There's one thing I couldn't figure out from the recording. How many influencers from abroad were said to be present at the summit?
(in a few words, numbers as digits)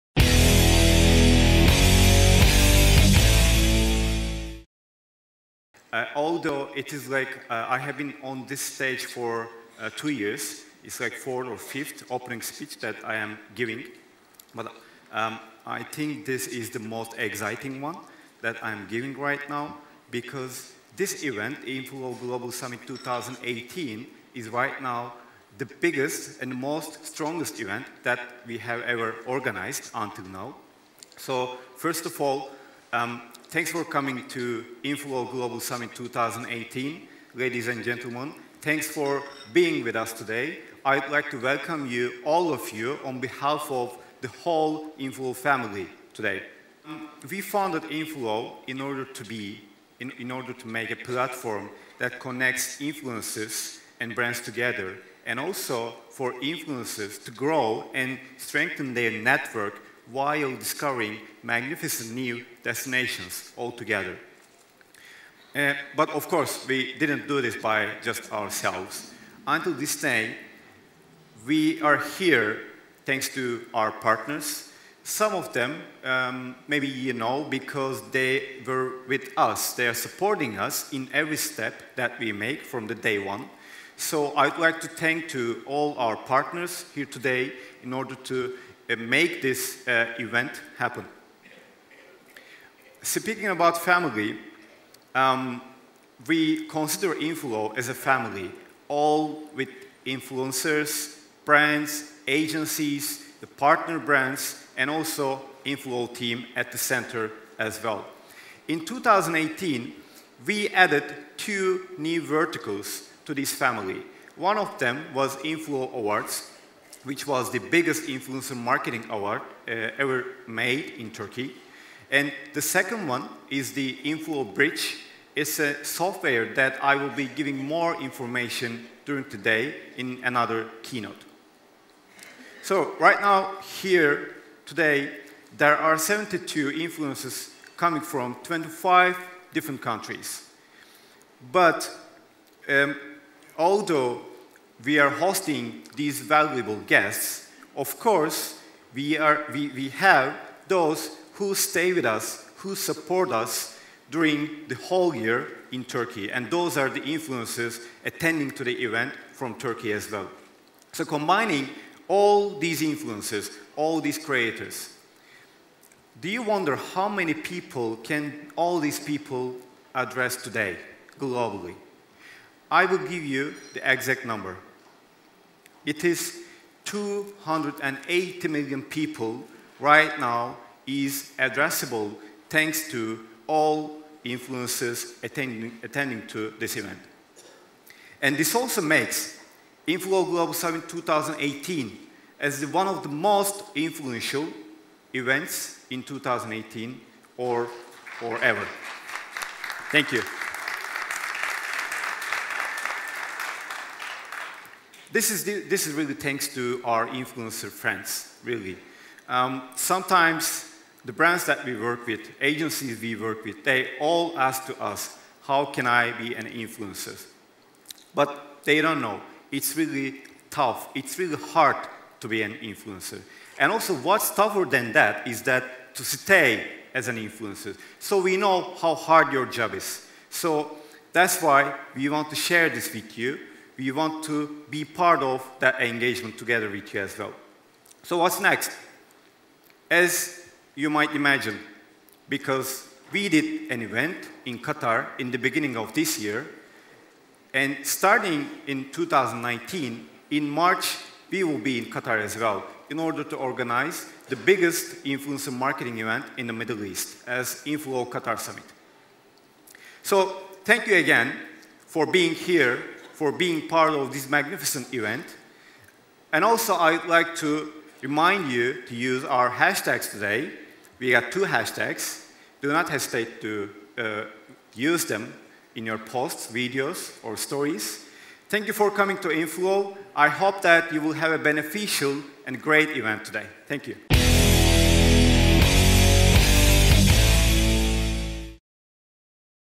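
72.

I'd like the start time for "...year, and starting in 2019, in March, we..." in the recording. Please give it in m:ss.
4:06.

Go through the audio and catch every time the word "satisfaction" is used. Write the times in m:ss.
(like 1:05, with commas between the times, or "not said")
not said.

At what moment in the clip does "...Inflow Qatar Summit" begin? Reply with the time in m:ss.
4:17.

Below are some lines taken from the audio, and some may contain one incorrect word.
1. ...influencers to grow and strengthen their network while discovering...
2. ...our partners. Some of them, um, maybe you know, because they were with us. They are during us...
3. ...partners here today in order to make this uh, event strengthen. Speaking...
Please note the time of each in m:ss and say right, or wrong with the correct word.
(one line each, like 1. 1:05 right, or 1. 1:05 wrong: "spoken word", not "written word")
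1. 0:56 right
2. 1:13 wrong: "supporting", not "during"
3. 1:26 wrong: "happen", not "strengthen".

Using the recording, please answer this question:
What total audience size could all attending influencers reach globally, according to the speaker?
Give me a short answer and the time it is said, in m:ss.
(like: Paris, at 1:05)
280 million people, at 2:56.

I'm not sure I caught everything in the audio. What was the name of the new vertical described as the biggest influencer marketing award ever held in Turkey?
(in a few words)
Inflow Awards.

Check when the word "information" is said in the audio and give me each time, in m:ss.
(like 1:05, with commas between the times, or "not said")
2:08.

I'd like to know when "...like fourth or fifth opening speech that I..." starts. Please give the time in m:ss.
0:11.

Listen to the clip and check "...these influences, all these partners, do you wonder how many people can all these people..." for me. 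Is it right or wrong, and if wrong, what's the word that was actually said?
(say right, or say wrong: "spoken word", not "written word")
wrong: "creators", not "partners".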